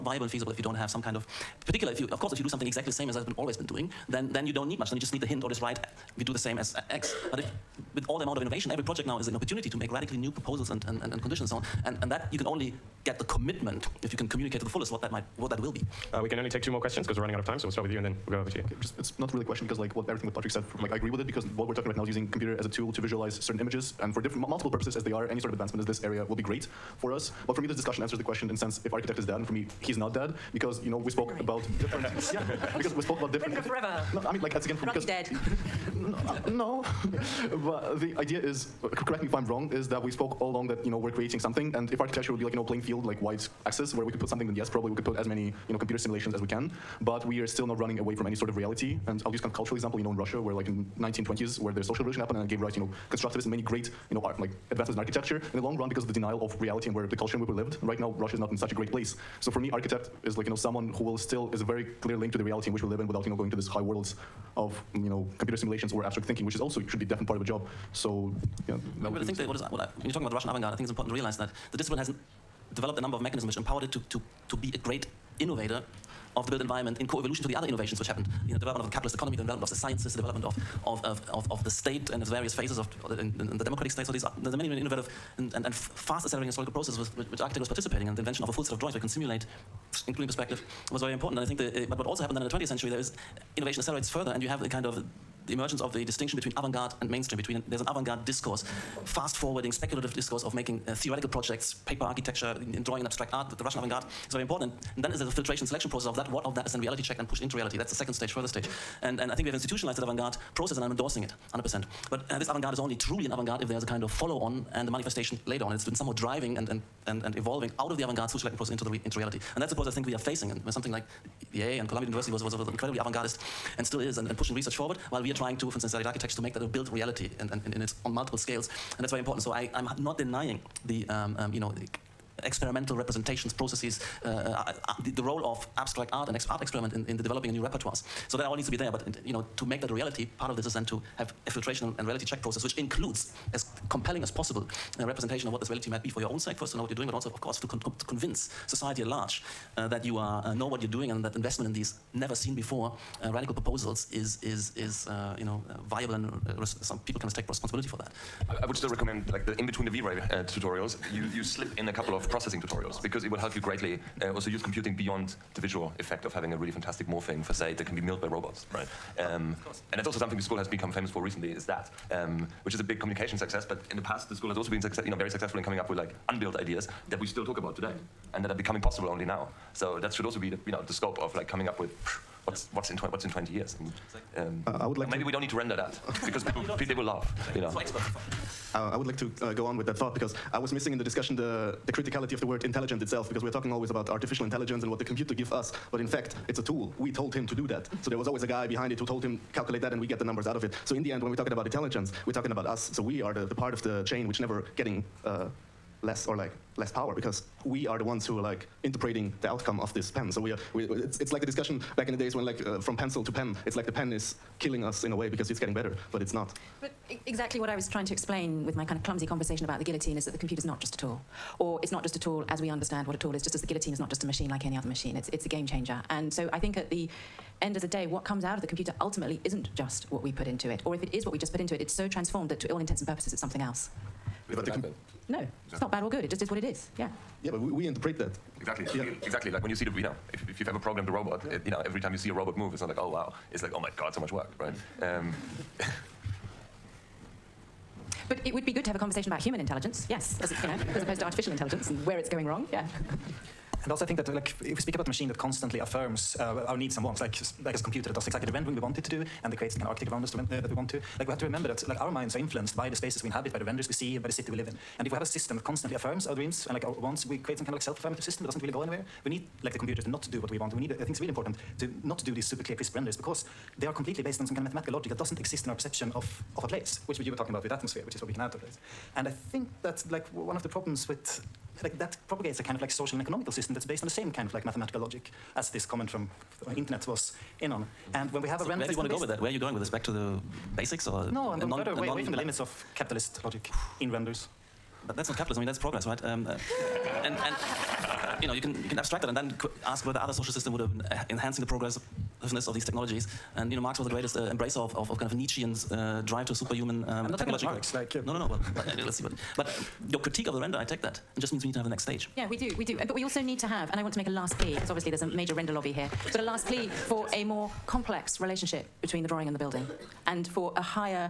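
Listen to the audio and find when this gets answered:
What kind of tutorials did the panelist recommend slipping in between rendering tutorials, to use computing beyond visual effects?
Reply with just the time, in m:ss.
2:42.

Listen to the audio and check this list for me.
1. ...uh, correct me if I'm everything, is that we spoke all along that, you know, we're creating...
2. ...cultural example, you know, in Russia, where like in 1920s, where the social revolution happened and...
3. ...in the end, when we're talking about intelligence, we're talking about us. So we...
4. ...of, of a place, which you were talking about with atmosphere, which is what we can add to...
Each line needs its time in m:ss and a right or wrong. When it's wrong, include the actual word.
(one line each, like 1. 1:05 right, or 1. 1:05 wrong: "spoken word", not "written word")
1. 0:38 wrong: "wrong", not "everything"
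2. 0:49 right
3. 3:20 right
4. 4:36 right.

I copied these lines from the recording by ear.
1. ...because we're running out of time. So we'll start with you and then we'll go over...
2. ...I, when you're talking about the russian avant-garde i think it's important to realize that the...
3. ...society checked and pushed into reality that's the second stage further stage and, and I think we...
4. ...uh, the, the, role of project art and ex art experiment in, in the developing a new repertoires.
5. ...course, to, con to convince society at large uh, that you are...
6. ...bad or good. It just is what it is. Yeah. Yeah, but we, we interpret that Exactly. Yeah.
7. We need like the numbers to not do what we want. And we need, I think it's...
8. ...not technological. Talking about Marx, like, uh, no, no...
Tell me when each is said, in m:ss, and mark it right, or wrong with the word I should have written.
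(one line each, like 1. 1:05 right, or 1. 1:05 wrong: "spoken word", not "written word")
1. 0:17 right
2. 1:09 right
3. 1:46 wrong: "reality", not "society"
4. 2:14 wrong: "abstract", not "project"
5. 2:27 right
6. 3:55 right
7. 4:29 wrong: "computers", not "numbers"
8. 5:07 right.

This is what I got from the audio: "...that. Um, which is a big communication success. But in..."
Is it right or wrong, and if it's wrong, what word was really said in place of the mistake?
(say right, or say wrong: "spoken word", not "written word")
right.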